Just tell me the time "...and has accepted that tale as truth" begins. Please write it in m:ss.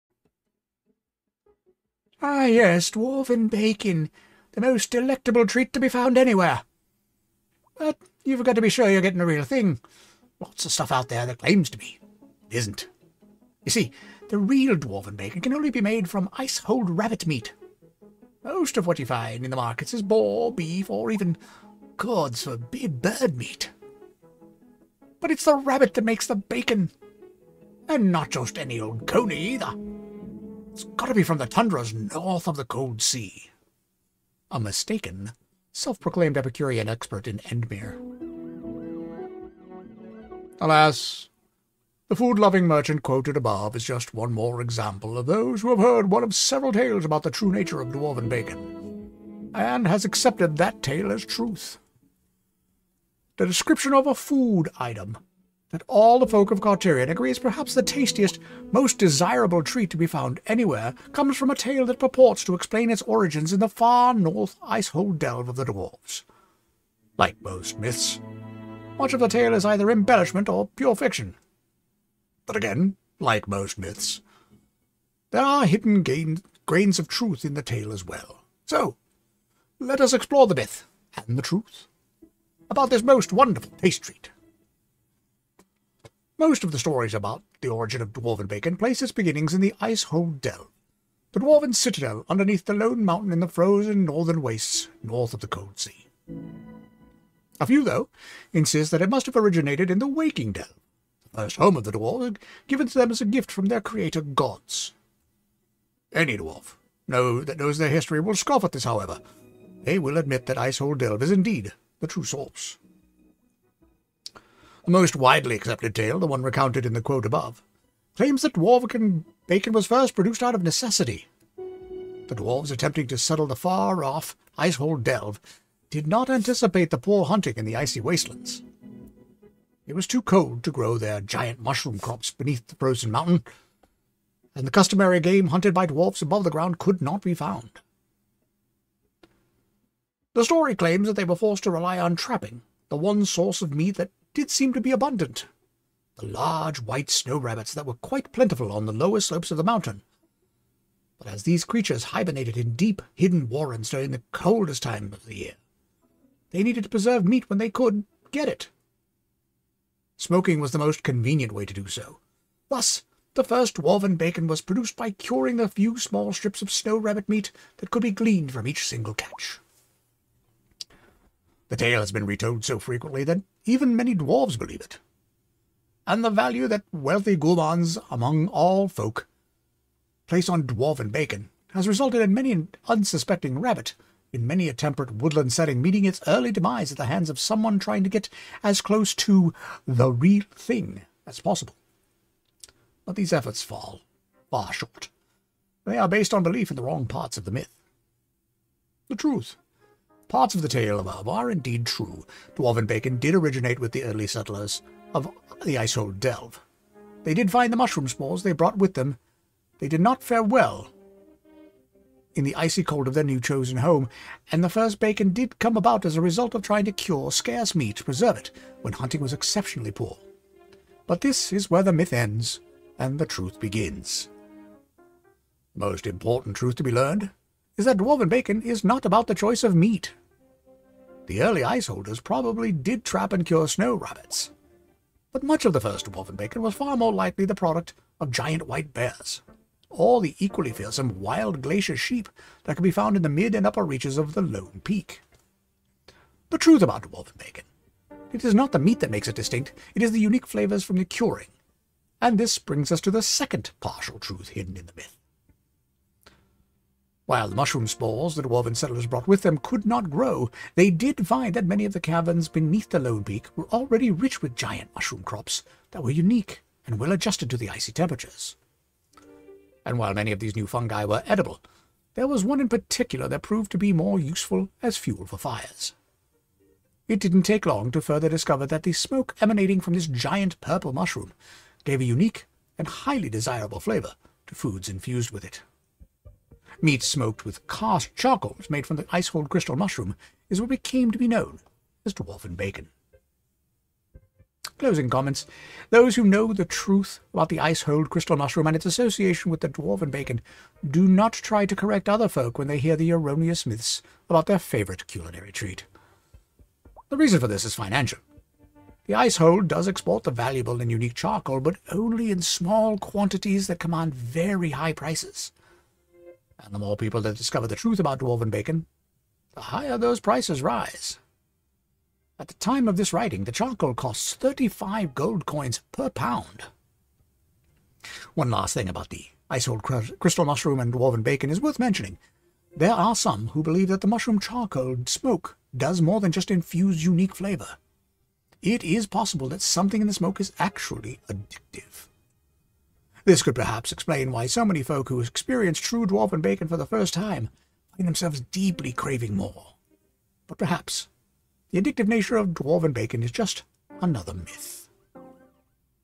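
0:49.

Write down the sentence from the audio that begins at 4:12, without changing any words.
And this brings us to the second partial truth hidden in the myth.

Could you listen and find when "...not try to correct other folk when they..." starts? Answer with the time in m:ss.
5:01.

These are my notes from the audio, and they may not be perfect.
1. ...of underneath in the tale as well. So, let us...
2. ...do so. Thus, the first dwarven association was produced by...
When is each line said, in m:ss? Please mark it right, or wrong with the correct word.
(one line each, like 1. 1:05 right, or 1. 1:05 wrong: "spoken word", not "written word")
1. 1:16 wrong: "truth", not "underneath"
2. 2:41 wrong: "bacon", not "association".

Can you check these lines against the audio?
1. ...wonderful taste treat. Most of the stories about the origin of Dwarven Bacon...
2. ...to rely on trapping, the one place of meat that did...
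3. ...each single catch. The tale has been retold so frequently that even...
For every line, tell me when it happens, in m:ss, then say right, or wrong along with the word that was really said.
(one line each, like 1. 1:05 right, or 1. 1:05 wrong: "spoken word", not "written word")
1. 1:23 right
2. 2:21 wrong: "source", not "place"
3. 2:48 right.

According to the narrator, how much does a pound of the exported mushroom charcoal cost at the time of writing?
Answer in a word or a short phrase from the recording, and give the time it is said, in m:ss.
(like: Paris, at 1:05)
35 gold coins, at 5:24.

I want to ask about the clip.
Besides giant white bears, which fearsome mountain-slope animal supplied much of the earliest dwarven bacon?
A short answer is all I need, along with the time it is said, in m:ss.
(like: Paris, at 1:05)
wild glacier sheep, at 4:01.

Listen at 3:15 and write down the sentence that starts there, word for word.
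They are based on belief in the wrong parts of the myth.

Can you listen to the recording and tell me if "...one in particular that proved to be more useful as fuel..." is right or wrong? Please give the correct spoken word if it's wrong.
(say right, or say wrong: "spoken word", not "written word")
right.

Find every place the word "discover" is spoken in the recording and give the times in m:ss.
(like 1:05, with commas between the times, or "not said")
4:38, 5:17.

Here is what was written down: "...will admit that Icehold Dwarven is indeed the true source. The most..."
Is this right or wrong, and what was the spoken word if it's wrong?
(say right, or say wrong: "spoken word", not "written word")
wrong: "Delve", not "Dwarven".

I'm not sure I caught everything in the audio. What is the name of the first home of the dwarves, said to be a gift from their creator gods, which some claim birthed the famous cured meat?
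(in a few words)
Waking Dell.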